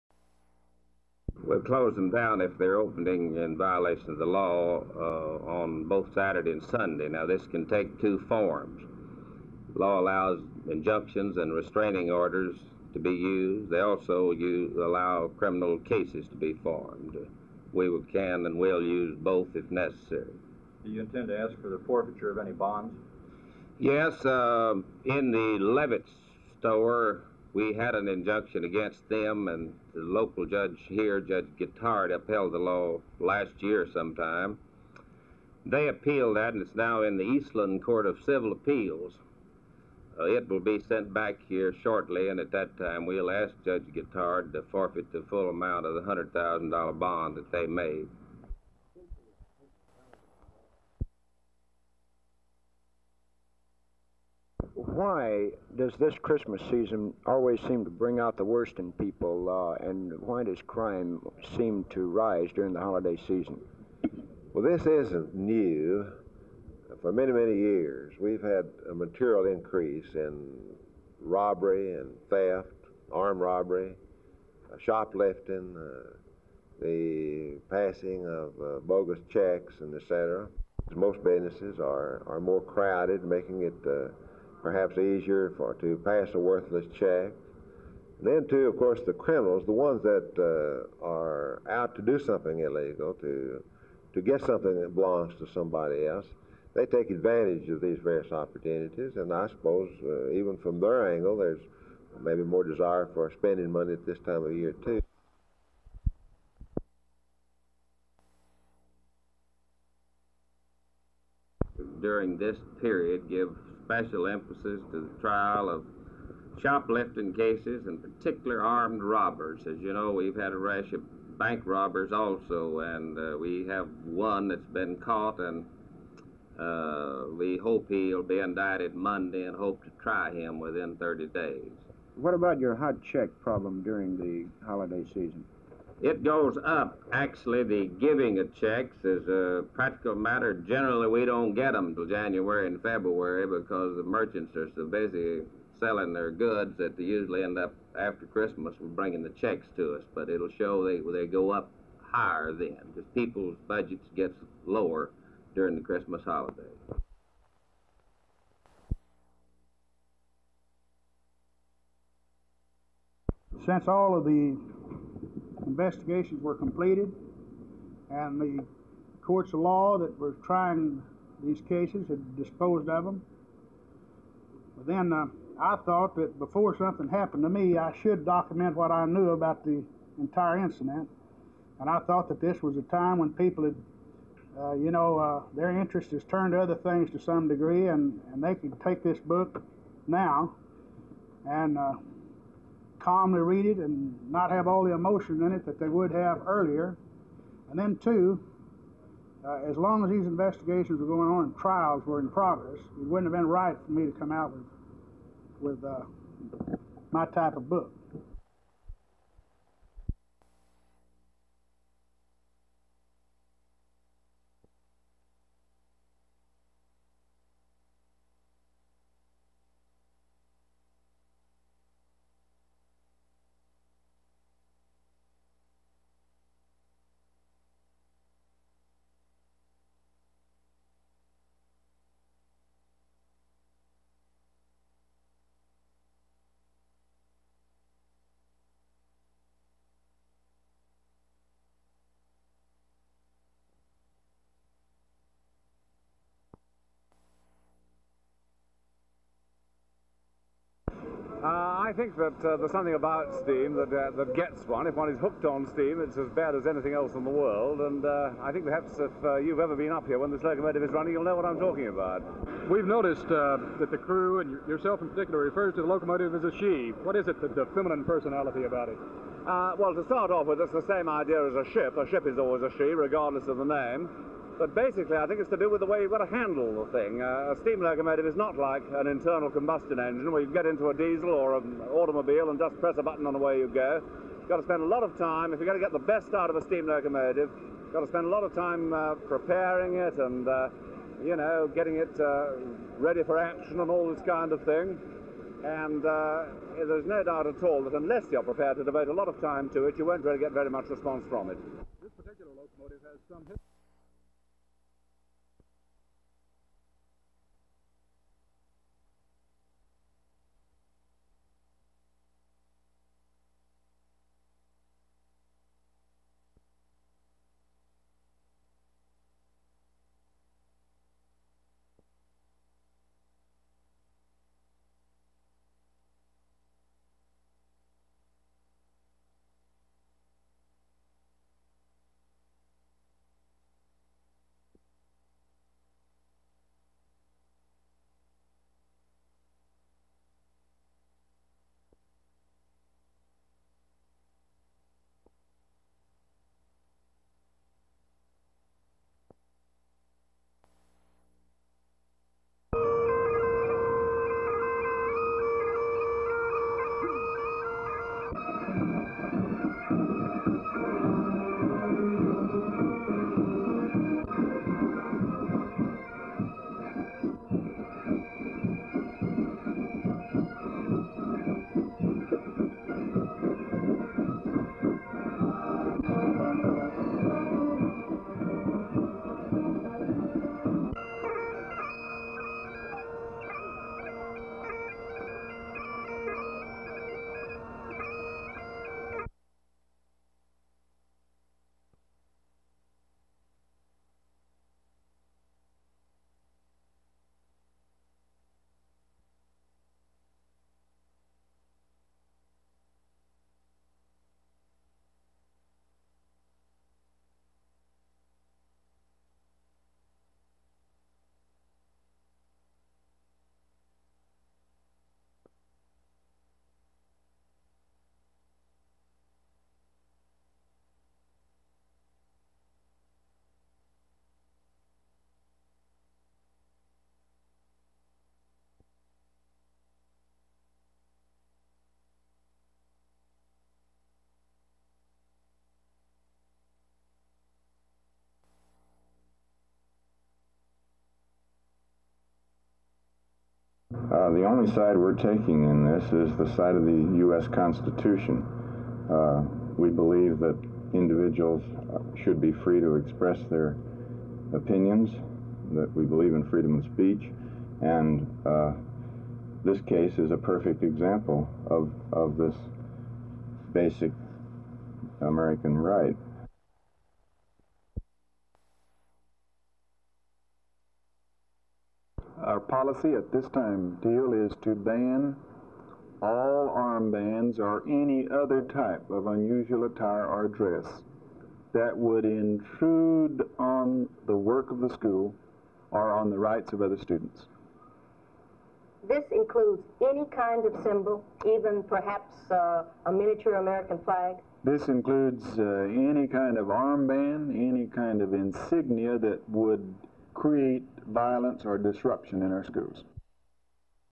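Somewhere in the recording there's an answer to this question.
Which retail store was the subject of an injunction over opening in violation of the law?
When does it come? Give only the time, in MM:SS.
00:25.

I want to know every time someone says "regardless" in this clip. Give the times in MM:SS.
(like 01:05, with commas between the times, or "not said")
04:32.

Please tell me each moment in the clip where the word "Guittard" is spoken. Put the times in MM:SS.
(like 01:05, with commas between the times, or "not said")
00:31, 00:43.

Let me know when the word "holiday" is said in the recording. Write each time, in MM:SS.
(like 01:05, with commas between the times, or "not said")
01:02, 02:14, 02:36.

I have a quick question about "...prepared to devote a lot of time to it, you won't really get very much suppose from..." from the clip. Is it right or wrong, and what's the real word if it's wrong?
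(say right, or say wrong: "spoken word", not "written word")
wrong: "response", not "suppose".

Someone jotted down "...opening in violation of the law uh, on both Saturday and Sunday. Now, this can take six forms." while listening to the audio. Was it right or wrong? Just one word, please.
wrong.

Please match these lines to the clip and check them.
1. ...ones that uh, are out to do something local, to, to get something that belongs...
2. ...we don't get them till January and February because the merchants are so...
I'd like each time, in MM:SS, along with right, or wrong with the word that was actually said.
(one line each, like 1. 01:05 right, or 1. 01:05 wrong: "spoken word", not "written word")
1. 01:29 wrong: "illegal", not "local"
2. 02:21 right.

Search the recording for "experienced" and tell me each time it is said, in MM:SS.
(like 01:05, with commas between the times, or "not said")
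not said.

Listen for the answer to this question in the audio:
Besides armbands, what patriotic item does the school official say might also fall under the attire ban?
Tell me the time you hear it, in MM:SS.
08:13.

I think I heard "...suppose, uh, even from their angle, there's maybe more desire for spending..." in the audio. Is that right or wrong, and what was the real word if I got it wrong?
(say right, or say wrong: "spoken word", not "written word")
right.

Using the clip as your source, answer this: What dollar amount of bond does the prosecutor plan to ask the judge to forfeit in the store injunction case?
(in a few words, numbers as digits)
$100,000.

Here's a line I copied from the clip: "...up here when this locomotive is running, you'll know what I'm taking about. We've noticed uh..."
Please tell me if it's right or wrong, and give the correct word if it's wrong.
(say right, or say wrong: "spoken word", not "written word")
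wrong: "talking", not "taking".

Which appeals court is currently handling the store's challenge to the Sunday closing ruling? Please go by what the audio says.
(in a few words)
Eastland Court of Civil Appeals.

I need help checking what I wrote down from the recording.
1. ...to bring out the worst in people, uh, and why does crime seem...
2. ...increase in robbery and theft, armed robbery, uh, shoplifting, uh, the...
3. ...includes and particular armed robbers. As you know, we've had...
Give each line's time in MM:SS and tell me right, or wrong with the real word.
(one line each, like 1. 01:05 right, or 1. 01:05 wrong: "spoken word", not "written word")
1. 00:57 right
2. 01:09 right
3. 01:57 wrong: "cases", not "includes".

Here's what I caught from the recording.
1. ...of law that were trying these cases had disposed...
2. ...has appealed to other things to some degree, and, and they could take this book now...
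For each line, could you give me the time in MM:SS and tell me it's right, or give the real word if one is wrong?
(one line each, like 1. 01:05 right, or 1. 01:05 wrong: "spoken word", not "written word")
1. 02:49 right
2. 03:06 wrong: "turned", not "appealed".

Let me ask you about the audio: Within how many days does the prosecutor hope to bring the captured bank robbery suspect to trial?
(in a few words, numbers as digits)
30 days.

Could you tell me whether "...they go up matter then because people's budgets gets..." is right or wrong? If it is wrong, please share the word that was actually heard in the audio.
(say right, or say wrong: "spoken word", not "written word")
wrong: "higher", not "matter".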